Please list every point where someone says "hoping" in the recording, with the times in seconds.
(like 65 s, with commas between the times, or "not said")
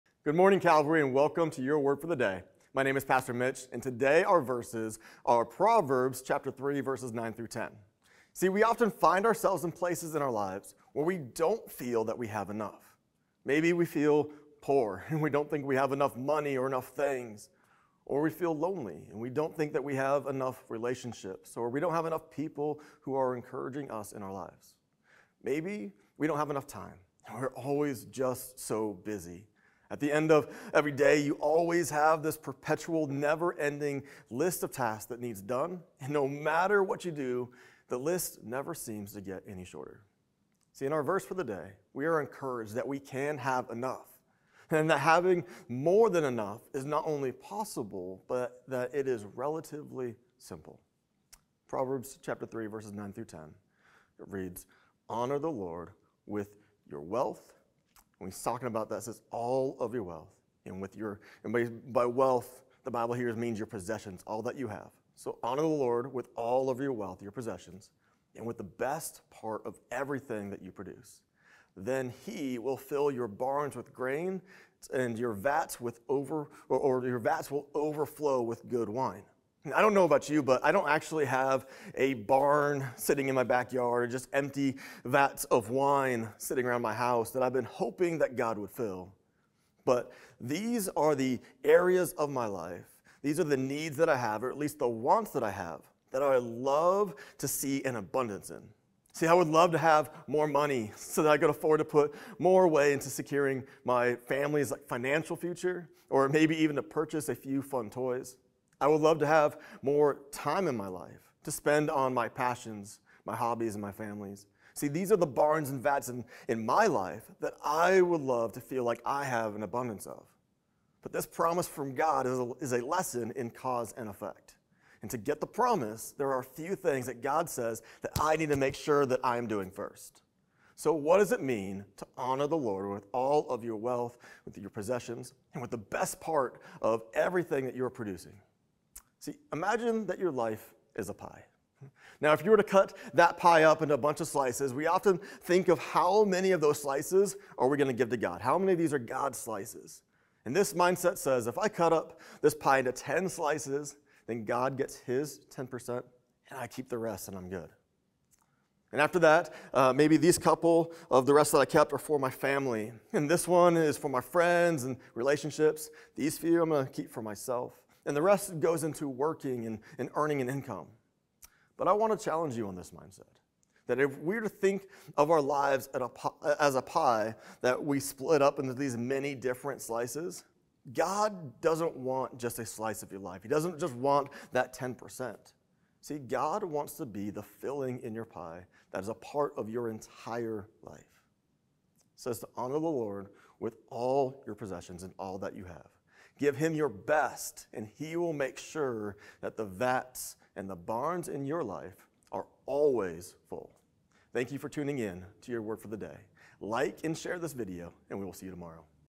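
87 s.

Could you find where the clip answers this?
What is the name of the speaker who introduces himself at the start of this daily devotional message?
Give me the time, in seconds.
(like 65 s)
3 s.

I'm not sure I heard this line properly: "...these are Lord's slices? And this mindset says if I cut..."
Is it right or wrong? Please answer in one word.
wrong.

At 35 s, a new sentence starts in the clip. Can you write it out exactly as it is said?
And no matter what you do, the list never seems to get any shorter.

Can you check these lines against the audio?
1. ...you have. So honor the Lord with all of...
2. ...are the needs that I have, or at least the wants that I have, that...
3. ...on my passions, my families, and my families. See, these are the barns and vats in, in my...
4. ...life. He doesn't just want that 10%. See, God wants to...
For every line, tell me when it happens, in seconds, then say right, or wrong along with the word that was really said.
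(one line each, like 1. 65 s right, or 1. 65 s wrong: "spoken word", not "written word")
1. 64 s right
2. 93 s right
3. 111 s wrong: "hobbies", not "families"
4. 183 s right.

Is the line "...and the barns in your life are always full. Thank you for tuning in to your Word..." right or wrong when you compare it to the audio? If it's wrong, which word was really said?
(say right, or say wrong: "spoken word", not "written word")
right.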